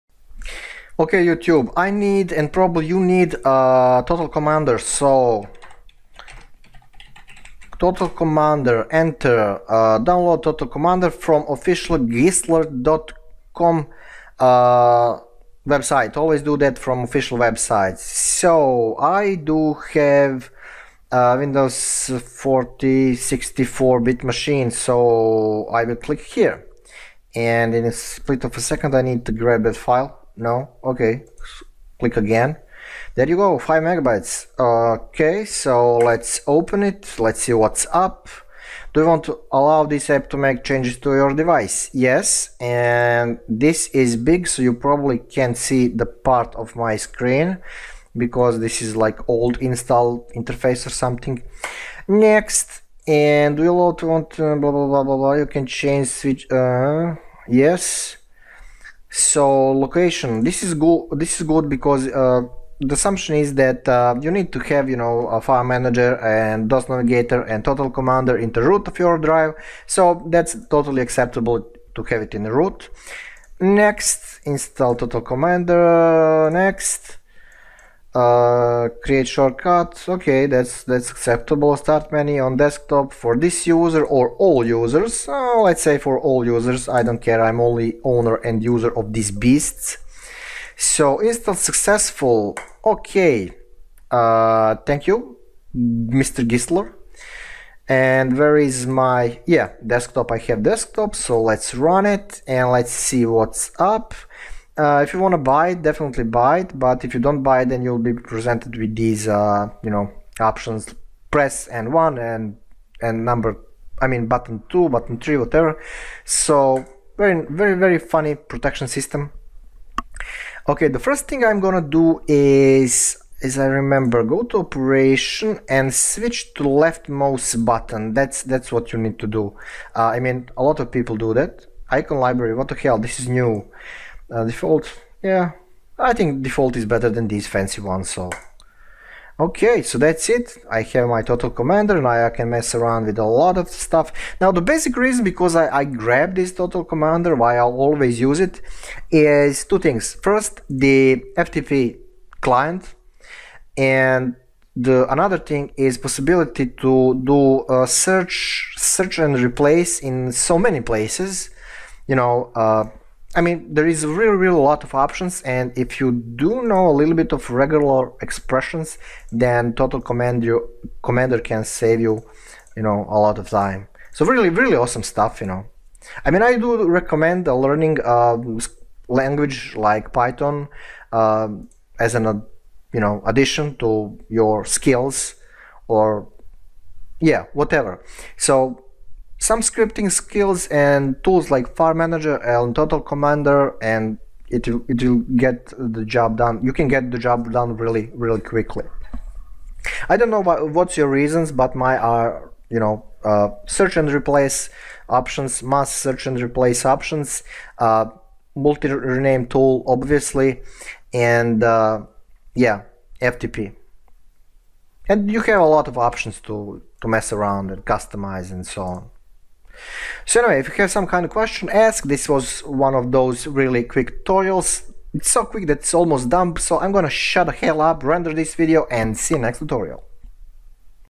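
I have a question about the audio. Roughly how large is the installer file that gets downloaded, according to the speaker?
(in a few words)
5 megabytes.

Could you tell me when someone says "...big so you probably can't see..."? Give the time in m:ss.
0:44.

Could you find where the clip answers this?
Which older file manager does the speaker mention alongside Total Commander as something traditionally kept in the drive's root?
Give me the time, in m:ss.
1:06.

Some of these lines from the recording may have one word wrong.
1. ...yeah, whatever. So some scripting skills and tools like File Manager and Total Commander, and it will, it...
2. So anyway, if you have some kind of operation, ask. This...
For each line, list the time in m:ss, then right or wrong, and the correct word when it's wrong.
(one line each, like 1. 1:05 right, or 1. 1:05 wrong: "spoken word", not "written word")
1. 3:07 right
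2. 3:40 wrong: "question", not "operation".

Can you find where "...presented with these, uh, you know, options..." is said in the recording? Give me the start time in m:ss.
1:48.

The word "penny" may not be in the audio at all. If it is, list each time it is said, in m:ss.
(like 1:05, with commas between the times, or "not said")
not said.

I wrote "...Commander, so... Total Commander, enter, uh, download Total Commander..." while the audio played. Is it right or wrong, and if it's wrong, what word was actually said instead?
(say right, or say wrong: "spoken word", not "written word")
right.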